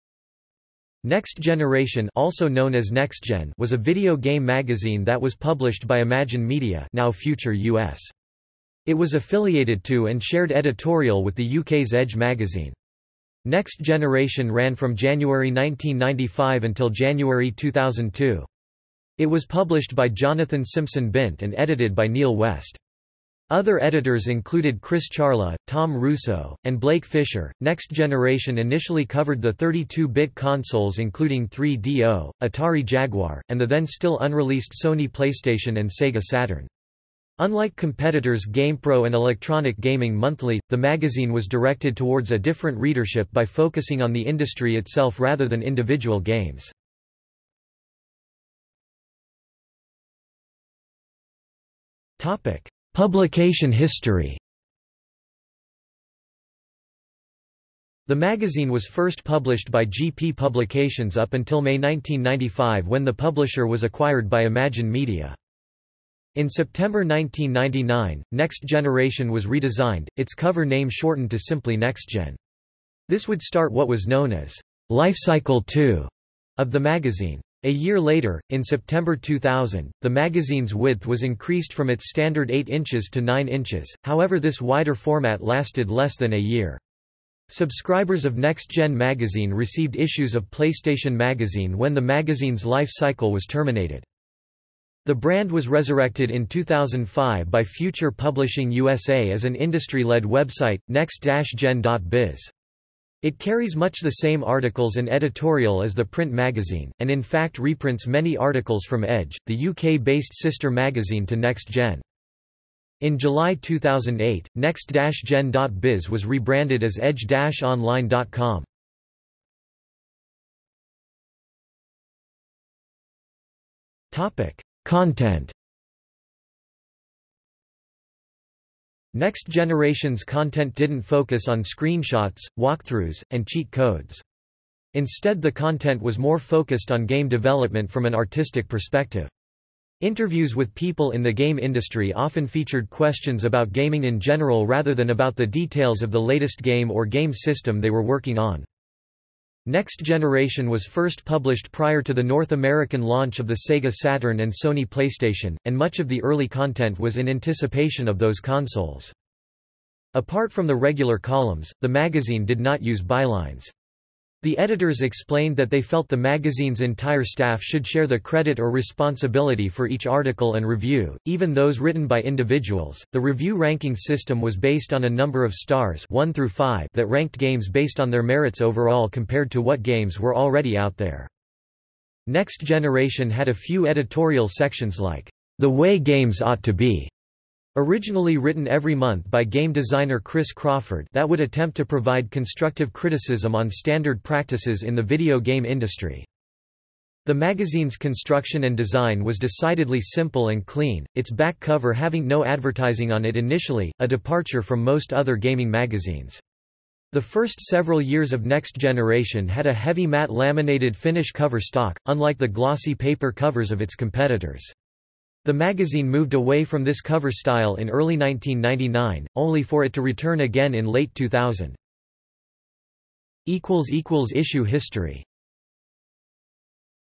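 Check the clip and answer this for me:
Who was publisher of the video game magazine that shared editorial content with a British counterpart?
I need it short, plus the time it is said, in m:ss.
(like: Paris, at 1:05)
Jonathan Simpson Bint, at 0:20.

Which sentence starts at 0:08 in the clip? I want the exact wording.
It was affiliated to and shared editorial with the UK's Edge magazine.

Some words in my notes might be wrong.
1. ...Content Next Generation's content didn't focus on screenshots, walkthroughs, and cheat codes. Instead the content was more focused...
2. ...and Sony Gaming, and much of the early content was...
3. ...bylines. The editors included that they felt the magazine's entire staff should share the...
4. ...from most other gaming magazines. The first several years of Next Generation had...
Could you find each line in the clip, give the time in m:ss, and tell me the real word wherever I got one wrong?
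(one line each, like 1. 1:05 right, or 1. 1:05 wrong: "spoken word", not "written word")
1. 2:04 right
2. 2:34 wrong: "PlayStation", not "Gaming"
3. 2:43 wrong: "explained", not "included"
4. 3:24 right.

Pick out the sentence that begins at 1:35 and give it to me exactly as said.
The brand was resurrected in 2005 by Future Publishing USA as an industry-led website, next-gen.biz.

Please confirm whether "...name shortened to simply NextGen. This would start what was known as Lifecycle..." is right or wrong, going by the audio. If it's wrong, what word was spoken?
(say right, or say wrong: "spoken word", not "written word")
right.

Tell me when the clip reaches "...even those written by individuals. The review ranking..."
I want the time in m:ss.
2:51.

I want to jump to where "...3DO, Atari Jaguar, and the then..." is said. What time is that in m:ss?
0:31.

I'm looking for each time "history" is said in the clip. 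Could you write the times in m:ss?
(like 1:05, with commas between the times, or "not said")
0:53, 3:44.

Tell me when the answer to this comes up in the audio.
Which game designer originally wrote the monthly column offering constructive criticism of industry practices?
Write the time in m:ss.
3:10.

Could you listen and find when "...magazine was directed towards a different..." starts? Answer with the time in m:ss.
0:40.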